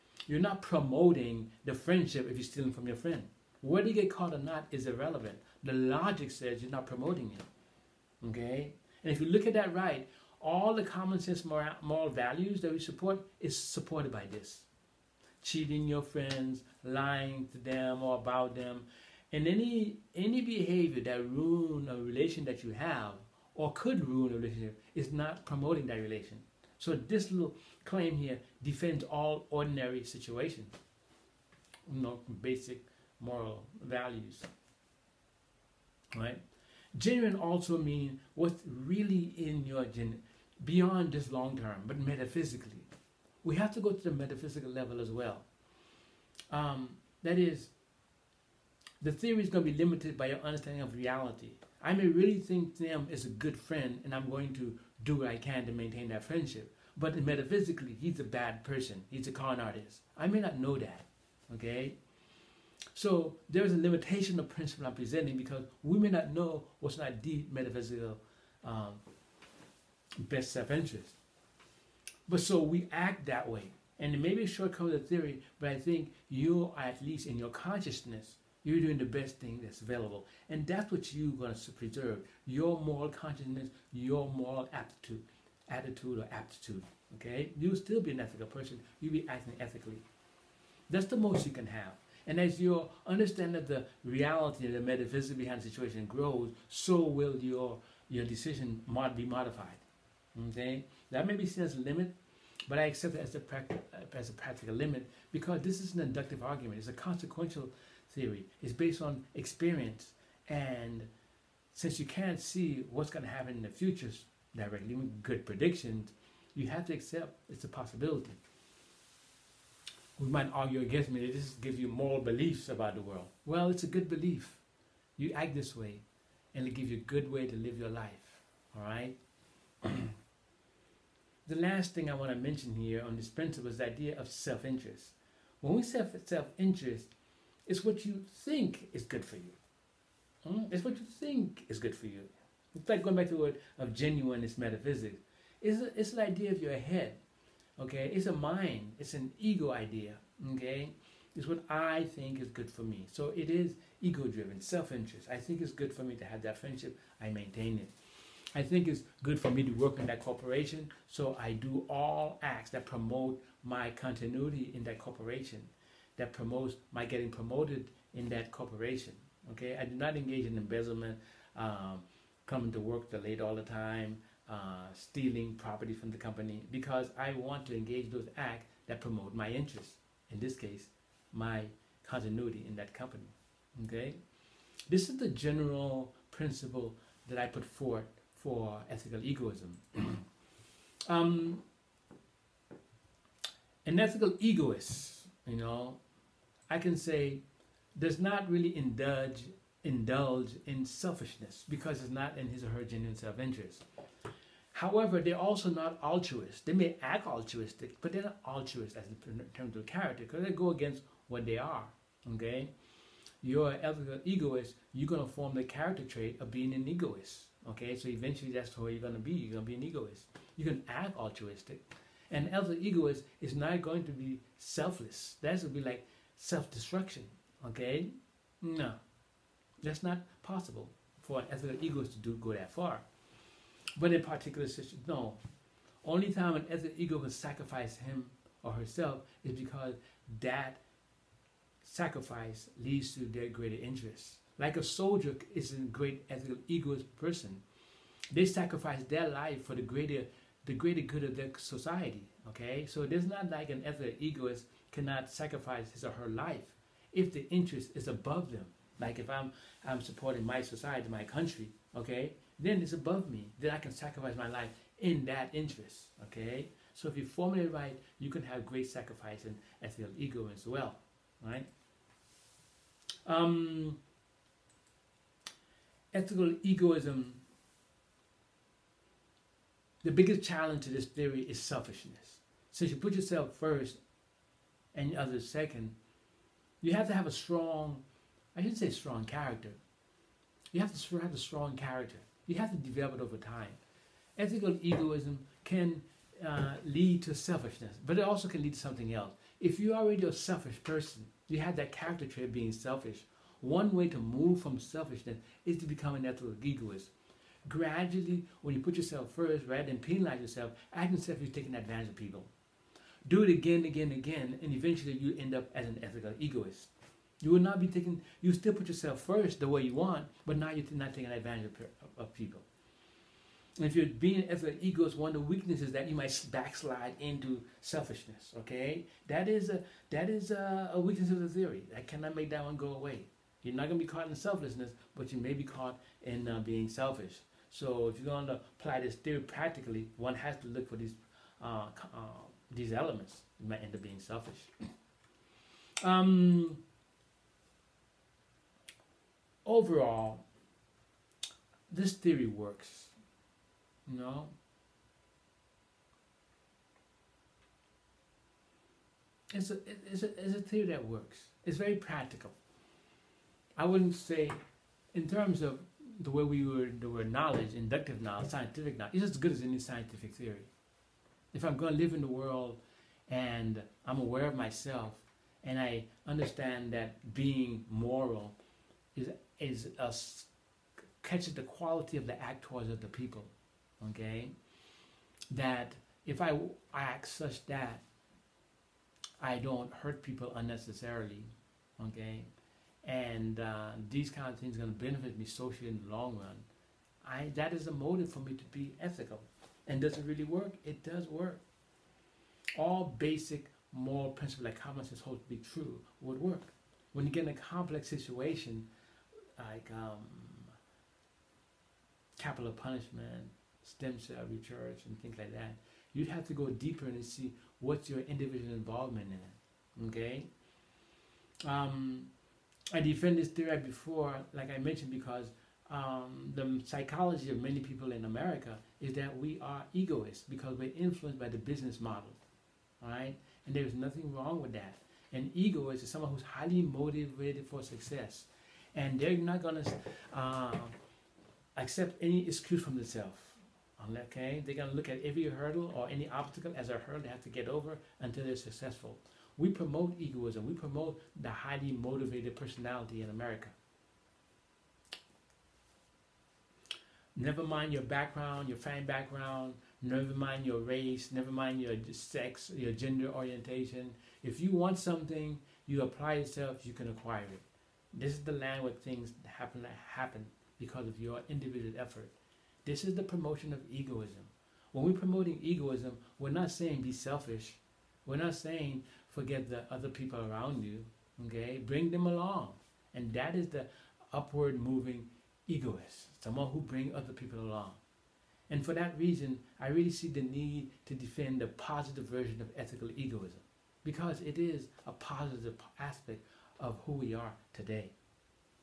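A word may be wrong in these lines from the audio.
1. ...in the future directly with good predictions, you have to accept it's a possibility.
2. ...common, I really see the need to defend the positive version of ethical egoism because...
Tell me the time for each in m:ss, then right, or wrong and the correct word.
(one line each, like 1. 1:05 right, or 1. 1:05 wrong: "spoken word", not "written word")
1. 1:53 right
2. 8:09 wrong: "reason", not "common".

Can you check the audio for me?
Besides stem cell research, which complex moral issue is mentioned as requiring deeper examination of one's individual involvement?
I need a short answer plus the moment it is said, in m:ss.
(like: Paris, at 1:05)
capital punishment, at 6:52.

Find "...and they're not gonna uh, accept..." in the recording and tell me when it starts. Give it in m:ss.
7:18.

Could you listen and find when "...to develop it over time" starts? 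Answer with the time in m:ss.
4:52.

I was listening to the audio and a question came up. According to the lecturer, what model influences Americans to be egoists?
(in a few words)
the business model.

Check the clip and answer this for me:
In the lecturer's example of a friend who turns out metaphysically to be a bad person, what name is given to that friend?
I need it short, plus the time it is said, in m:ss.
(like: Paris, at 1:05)
Sam, at 0:52.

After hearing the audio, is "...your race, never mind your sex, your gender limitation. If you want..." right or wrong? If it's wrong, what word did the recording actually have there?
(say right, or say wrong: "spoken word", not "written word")
wrong: "orientation", not "limitation".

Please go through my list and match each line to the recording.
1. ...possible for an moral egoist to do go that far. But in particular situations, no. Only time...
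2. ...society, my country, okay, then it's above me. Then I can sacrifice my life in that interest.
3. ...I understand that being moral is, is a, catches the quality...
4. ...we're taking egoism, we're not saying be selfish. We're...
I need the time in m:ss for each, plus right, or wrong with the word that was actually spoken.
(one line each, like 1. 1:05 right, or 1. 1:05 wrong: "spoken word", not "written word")
1. 3:50 wrong: "ethical", not "moral"
2. 4:20 right
3. 6:15 right
4. 7:55 wrong: "promoting", not "taking".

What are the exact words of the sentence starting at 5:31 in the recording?
I cannot make that one go away.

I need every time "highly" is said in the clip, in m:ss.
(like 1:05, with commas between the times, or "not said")
7:16, 7:31.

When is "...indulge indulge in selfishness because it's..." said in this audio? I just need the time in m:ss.
3:18.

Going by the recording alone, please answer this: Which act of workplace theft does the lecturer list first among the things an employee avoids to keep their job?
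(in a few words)
embezzlement.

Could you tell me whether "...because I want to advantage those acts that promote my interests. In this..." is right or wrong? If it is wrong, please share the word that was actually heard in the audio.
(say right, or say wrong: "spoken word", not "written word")
wrong: "engage", not "advantage".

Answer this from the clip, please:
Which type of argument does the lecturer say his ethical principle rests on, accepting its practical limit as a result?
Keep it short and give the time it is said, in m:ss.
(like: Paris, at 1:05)
inductive argument, at 1:46.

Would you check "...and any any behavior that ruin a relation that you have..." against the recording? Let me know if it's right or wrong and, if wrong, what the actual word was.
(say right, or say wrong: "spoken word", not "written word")
right.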